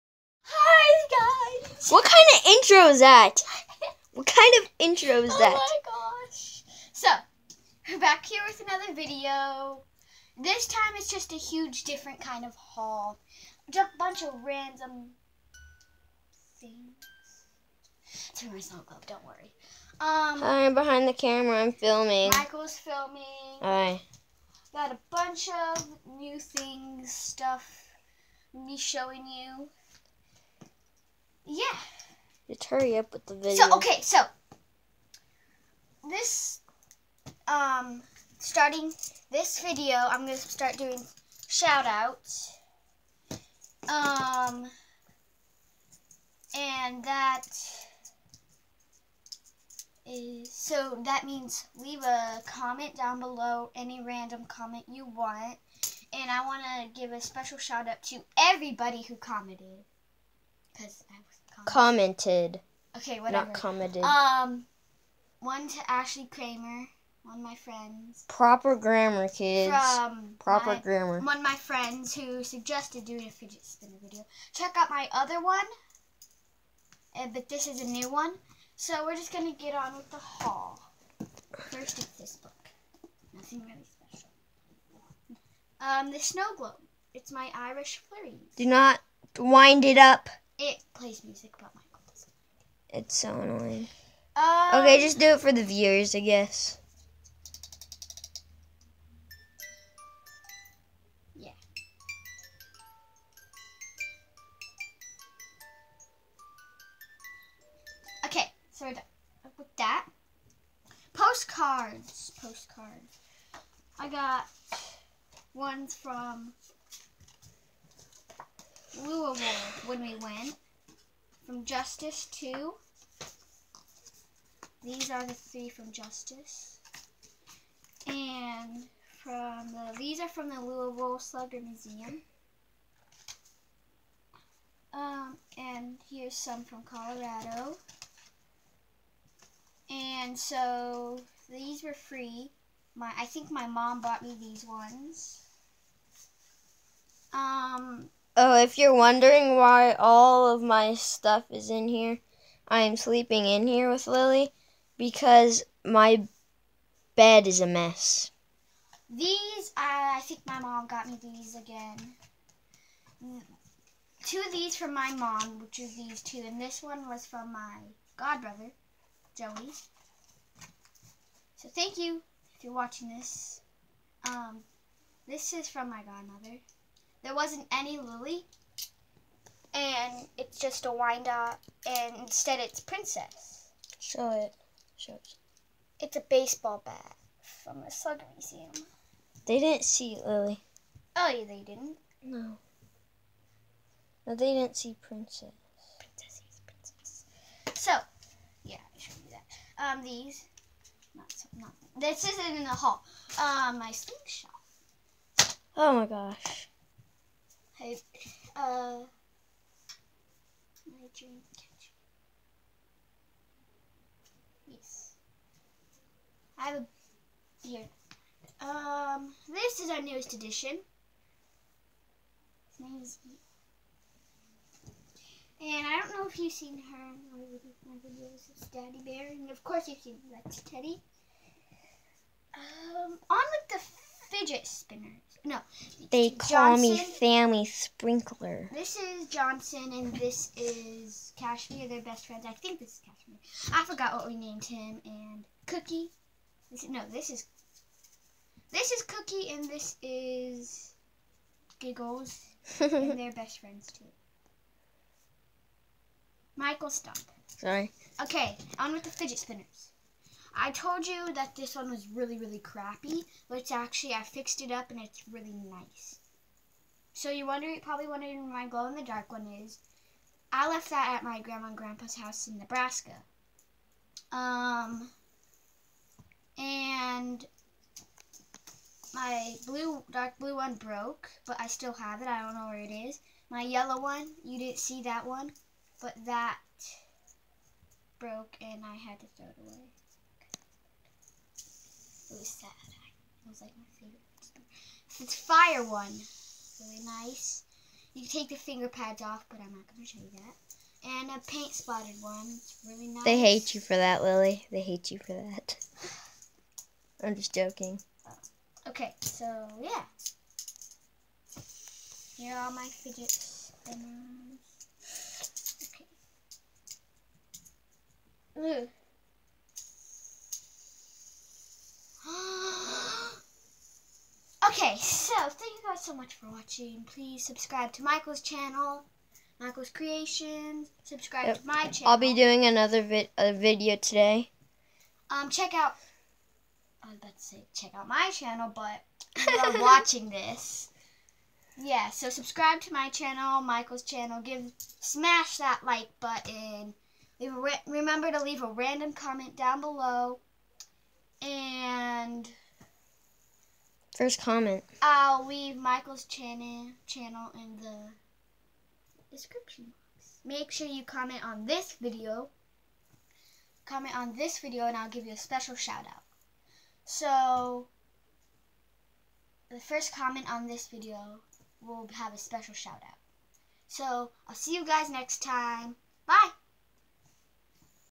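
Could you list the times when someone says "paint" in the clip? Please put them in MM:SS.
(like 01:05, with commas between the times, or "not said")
05:01.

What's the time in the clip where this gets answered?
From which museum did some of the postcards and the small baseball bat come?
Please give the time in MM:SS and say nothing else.
02:10.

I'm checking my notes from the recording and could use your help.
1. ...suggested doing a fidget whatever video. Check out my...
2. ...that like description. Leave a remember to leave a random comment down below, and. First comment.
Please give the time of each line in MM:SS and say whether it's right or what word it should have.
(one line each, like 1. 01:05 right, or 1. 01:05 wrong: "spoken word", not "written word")
1. 01:12 wrong: "spinner", not "whatever"
2. 05:45 wrong: "button", not "description".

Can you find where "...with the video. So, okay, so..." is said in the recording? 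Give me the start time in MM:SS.
00:33.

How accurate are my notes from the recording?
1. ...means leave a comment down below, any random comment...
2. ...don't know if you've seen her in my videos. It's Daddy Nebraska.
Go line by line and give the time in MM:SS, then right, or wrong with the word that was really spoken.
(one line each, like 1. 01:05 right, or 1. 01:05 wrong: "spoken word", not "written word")
1. 00:51 right
2. 03:45 wrong: "Bear", not "Nebraska".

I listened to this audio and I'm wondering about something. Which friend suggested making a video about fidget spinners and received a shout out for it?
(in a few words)
Ashley Kramer.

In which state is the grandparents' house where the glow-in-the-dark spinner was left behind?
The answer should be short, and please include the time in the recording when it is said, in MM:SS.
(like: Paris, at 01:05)
Nebraska, at 04:32.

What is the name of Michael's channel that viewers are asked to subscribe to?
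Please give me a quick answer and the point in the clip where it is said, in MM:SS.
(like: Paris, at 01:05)
Michael's Creations, at 05:29.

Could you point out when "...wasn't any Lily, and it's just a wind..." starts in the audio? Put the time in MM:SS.
02:57.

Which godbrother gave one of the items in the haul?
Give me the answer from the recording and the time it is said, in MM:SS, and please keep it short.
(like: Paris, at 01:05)
Joey, at 02:49.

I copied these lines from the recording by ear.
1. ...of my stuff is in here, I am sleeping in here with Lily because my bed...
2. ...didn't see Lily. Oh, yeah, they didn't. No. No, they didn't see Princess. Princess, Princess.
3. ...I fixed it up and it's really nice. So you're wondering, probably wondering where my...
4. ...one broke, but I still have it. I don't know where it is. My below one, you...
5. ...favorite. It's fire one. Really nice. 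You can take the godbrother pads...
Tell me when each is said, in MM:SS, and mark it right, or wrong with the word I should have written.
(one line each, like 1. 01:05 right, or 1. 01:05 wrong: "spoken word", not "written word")
1. 02:30 right
2. 03:09 right
3. 04:24 right
4. 04:40 wrong: "yellow", not "below"
5. 04:53 wrong: "finger", not "godbrother".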